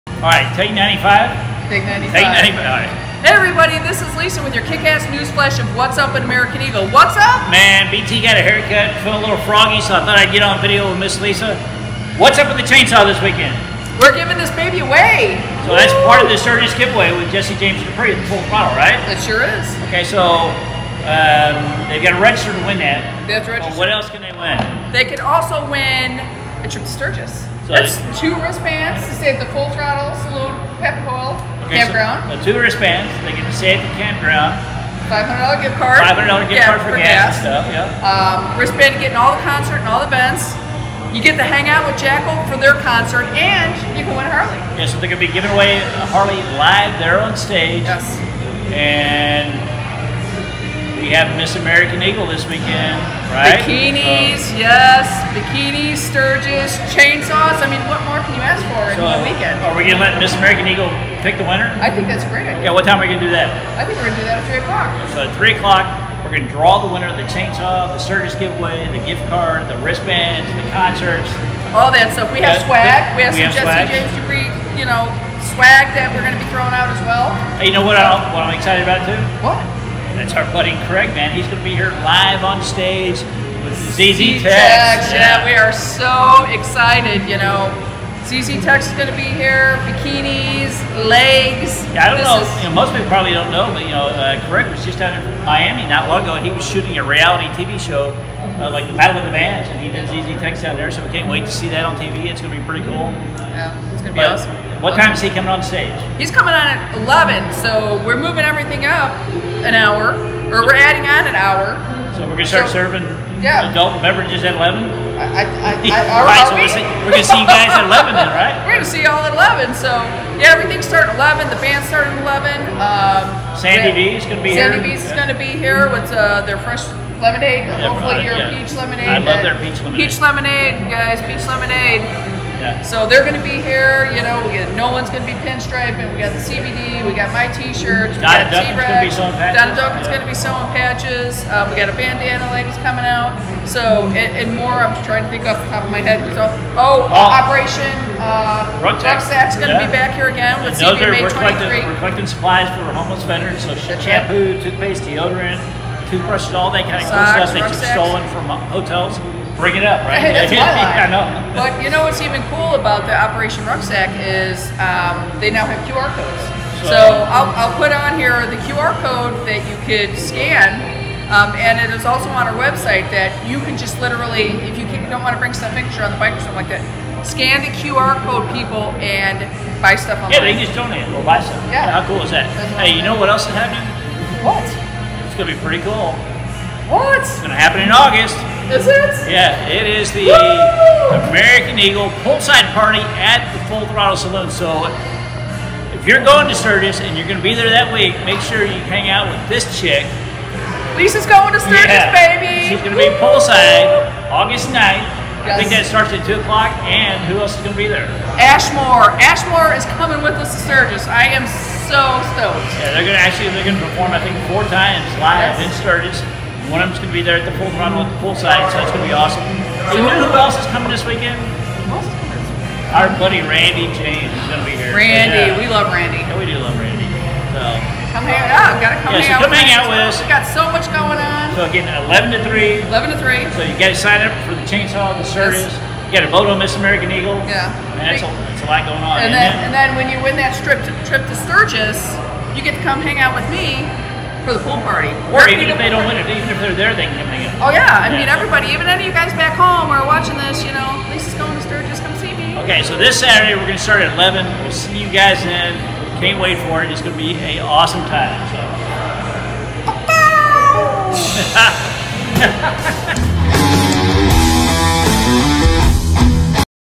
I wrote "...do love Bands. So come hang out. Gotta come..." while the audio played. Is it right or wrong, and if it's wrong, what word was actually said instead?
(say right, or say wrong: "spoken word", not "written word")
wrong: "Randy", not "Bands".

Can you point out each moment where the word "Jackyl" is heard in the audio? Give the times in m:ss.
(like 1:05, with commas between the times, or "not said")
0:42.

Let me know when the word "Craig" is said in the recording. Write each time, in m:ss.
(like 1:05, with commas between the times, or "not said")
1:20, 1:34.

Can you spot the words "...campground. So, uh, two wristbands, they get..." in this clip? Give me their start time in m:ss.
0:31.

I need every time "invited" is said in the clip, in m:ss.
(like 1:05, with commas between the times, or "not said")
not said.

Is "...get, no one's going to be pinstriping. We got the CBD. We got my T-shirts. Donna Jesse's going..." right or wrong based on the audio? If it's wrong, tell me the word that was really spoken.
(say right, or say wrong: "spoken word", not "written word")
wrong: "Duncan", not "Jesse".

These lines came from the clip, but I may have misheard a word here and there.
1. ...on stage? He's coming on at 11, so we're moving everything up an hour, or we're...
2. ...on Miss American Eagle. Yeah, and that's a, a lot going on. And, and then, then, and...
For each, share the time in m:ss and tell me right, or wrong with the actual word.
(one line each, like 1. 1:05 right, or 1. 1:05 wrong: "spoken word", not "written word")
1. 1:45 right
2. 3:56 right.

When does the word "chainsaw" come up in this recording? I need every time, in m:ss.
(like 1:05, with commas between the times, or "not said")
0:12, 0:56, 1:07, 3:54.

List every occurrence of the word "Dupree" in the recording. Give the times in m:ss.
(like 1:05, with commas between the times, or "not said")
0:17, 1:14.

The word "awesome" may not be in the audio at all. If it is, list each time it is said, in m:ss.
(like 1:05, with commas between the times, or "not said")
1:44, 3:39, 4:17.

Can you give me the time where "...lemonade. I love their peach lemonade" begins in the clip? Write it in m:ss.
2:08.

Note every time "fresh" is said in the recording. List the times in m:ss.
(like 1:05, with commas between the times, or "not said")
2:06.